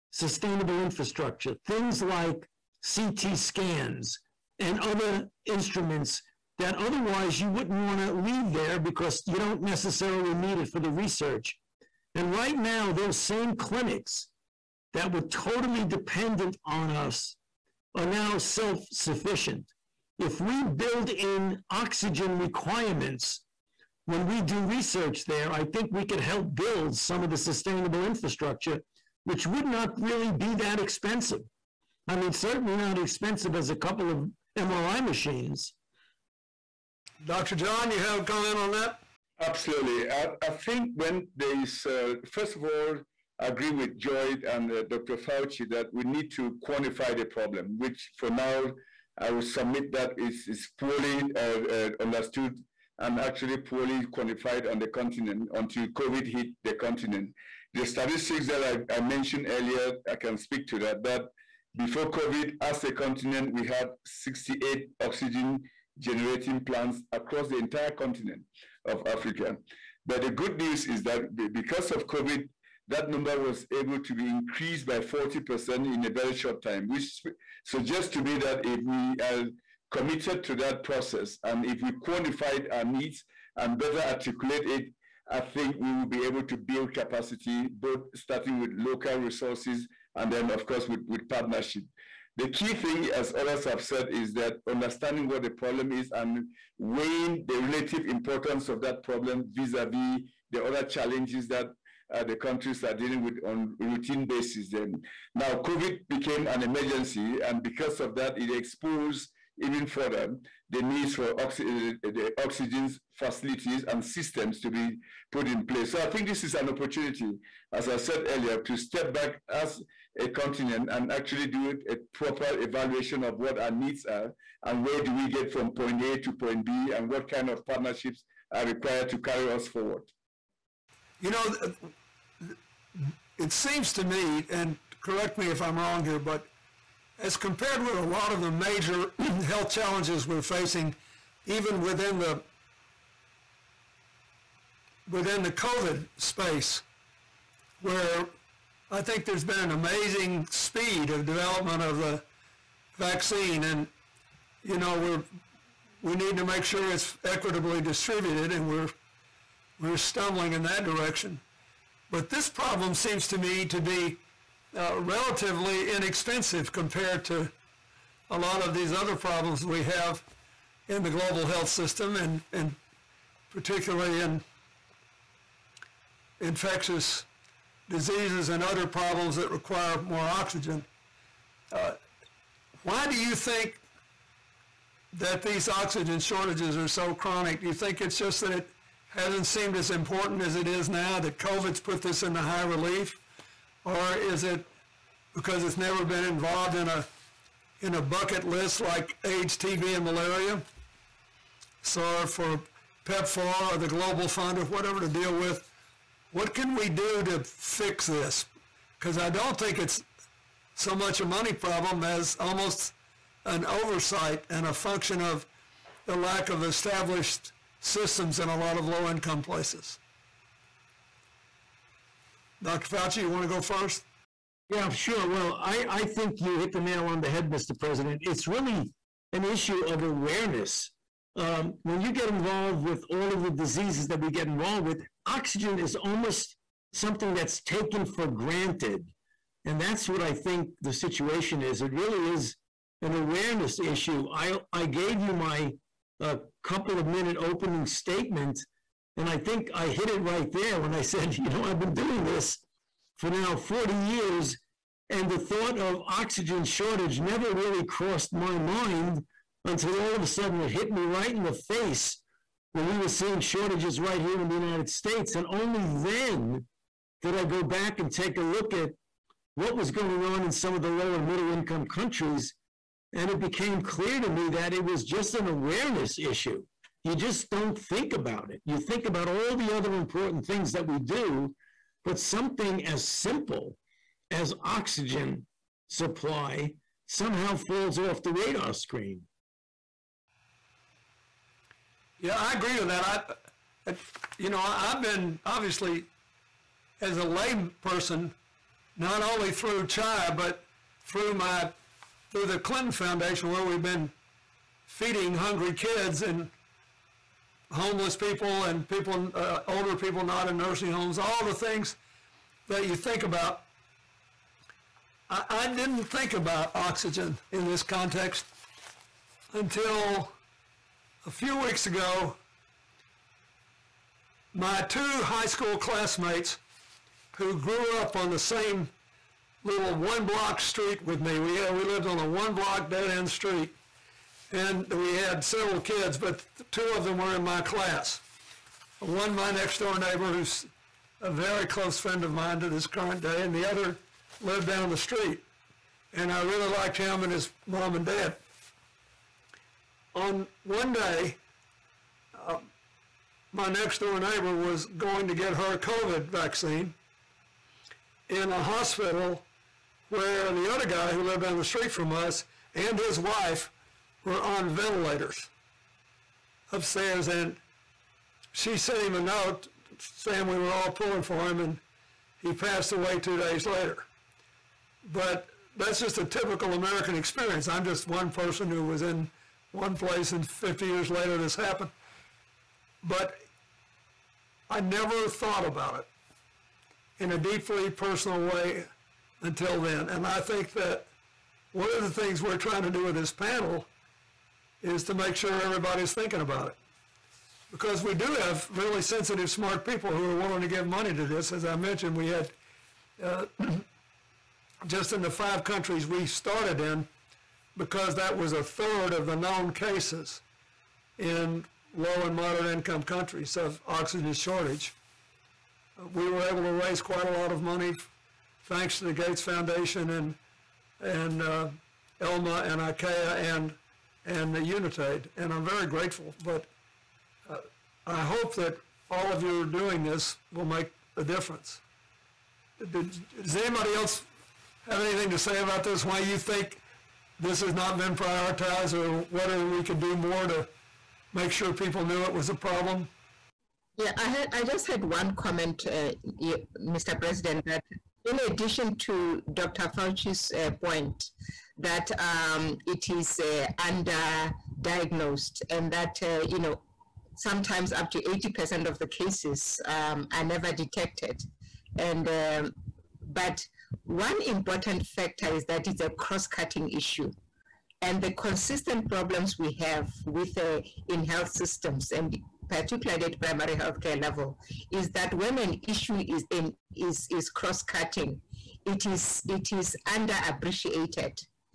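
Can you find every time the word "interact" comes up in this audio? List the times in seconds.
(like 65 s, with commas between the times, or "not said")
not said.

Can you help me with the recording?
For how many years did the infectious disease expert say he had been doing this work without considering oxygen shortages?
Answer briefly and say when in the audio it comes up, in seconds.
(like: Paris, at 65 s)
40 years, at 253 s.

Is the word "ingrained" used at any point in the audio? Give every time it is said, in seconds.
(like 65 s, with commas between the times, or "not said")
not said.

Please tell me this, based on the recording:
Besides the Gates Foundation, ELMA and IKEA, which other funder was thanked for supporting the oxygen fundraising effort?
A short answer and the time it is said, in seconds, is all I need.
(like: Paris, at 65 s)
Unitaid, at 424 s.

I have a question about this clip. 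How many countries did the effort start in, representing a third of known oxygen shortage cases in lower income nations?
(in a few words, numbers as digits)
5.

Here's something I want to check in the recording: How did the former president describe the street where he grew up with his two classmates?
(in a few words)
one block dead end street.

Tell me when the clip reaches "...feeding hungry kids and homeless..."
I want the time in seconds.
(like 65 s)
304 s.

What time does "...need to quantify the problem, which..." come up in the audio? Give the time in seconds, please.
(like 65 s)
46 s.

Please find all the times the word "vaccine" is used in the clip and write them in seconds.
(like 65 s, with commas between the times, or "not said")
152 s, 356 s.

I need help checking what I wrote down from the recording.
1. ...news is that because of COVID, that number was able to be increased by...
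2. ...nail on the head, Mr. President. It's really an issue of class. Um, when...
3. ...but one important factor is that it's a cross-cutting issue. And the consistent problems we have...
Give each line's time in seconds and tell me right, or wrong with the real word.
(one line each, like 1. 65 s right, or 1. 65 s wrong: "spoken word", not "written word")
1. 70 s right
2. 226 s wrong: "awareness", not "class"
3. 463 s right.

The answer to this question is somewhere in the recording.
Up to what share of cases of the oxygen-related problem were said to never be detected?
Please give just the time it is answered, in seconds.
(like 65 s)
458 s.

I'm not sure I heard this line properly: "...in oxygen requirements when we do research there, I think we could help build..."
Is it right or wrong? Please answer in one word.
right.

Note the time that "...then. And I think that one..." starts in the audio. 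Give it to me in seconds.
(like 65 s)
389 s.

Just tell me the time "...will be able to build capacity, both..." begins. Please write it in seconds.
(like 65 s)
85 s.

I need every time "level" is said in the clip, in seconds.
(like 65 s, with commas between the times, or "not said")
474 s.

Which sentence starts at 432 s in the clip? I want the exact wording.
Did, does anybody else have anything to say about this?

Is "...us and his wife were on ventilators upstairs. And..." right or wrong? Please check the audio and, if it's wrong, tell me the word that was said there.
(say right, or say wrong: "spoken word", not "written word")
right.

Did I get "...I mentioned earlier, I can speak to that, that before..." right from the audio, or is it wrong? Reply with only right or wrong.
right.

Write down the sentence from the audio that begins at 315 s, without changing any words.
I, I didn't think about oxygen in this context until a few weeks ago.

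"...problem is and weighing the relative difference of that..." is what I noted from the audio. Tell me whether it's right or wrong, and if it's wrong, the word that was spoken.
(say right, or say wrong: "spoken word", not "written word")
wrong: "importance", not "difference".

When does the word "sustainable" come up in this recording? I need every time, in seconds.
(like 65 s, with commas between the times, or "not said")
0 s, 27 s.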